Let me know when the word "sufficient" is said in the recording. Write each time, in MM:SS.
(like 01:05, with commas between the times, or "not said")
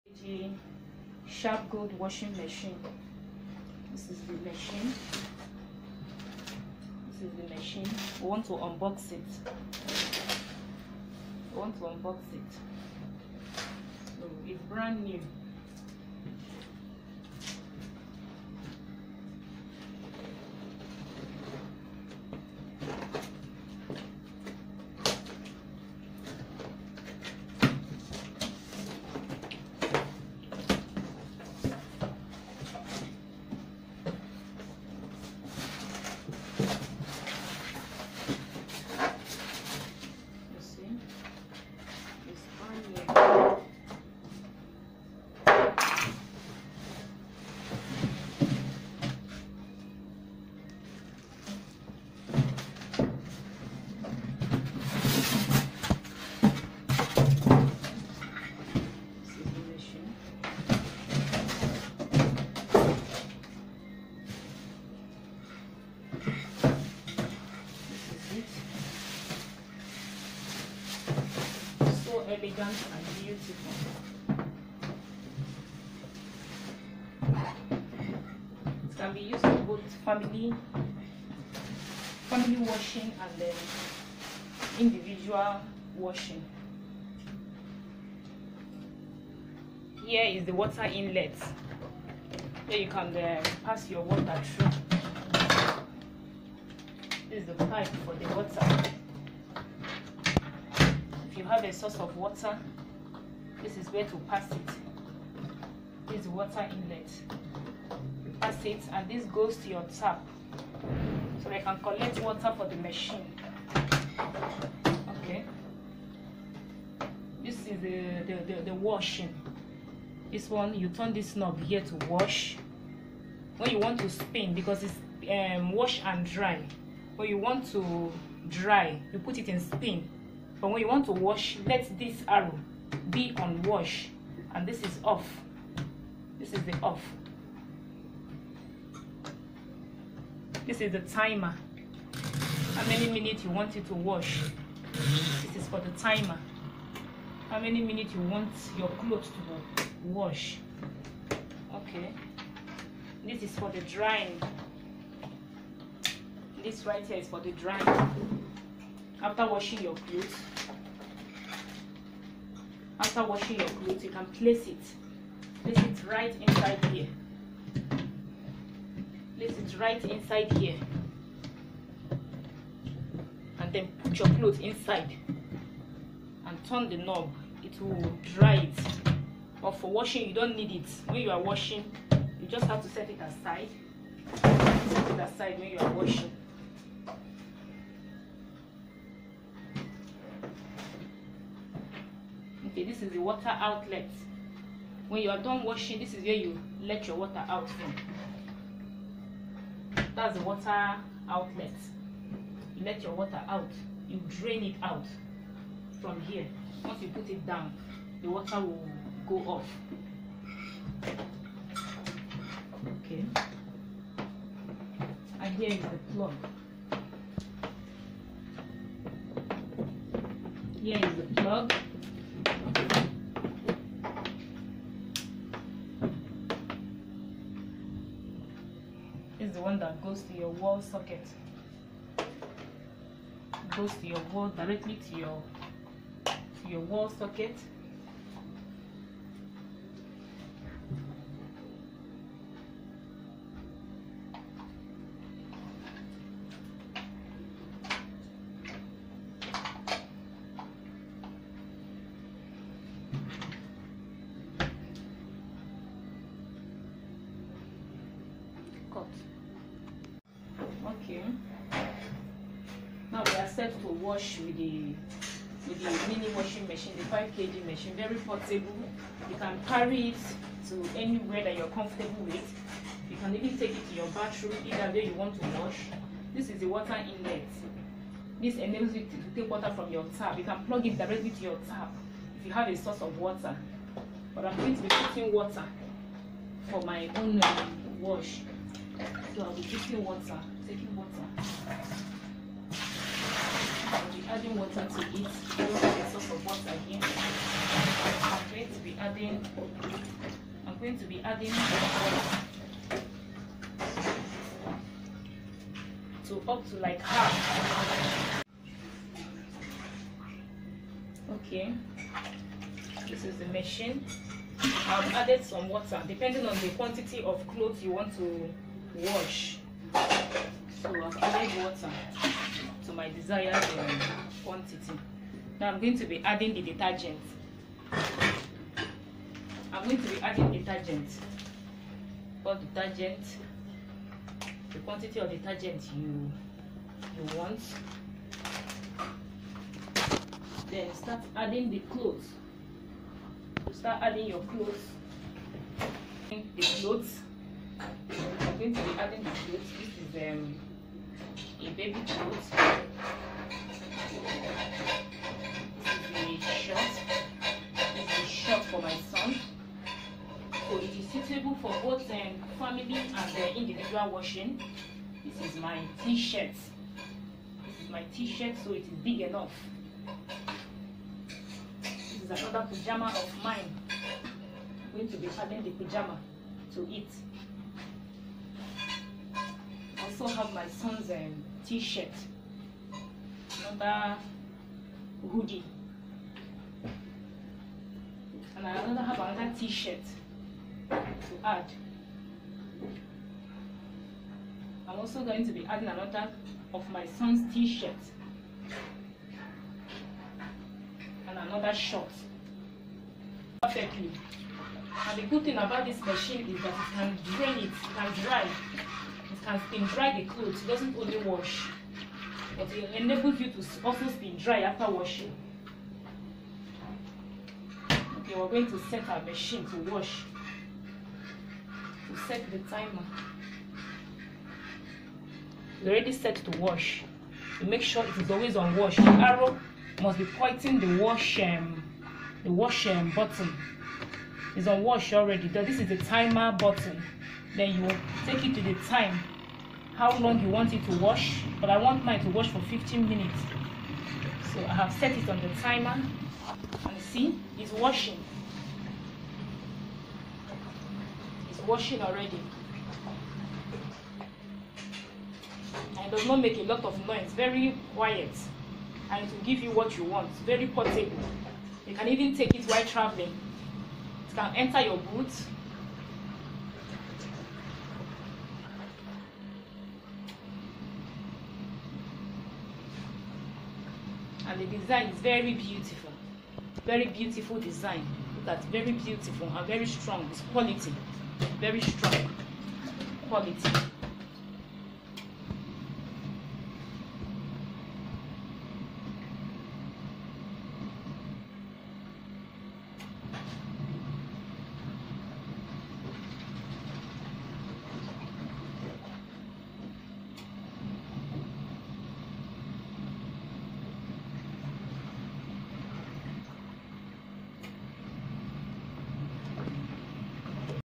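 not said.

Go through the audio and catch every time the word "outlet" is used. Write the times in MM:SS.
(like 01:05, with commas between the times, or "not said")
03:13, 03:21.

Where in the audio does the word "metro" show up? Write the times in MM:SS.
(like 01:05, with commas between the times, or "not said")
not said.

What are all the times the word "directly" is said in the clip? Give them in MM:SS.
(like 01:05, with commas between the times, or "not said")
03:54, 04:40.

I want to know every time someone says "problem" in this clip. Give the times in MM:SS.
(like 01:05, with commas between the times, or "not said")
not said.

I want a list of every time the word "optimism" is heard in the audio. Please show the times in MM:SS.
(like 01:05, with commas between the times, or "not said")
not said.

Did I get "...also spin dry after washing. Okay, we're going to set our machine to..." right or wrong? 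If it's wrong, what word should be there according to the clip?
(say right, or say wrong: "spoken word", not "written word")
right.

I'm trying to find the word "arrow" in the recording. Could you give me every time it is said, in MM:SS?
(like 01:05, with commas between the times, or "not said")
02:12, 07:09.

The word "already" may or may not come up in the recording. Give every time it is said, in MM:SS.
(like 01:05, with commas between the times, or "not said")
07:05, 07:15, 07:32.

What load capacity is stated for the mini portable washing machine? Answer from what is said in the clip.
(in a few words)
5 kg.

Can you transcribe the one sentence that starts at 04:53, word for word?
I'll be adding water to it.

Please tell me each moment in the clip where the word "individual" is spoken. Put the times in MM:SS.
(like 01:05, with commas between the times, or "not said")
01:24, 06:03.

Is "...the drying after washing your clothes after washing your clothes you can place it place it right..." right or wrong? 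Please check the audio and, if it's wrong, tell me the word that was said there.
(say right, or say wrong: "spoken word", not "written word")
right.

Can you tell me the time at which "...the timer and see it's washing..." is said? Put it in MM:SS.
07:25.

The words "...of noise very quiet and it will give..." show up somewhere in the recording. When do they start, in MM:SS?
07:36.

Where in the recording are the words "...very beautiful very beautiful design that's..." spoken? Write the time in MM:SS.
07:55.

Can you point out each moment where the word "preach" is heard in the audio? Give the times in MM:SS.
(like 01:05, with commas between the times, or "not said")
not said.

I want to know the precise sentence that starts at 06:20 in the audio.
also have my son's um, t-shirt, another hoodie, and I another have another t-shirt to add.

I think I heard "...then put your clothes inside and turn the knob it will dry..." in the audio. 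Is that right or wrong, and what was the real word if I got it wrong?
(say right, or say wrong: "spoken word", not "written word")
right.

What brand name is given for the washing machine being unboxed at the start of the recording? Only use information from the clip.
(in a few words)
Sharpgold.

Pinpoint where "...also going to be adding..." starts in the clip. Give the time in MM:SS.
06:34.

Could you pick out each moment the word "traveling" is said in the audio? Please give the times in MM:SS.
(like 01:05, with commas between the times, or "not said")
07:42.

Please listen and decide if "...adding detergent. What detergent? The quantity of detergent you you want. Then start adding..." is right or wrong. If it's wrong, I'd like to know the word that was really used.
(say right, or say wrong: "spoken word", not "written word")
right.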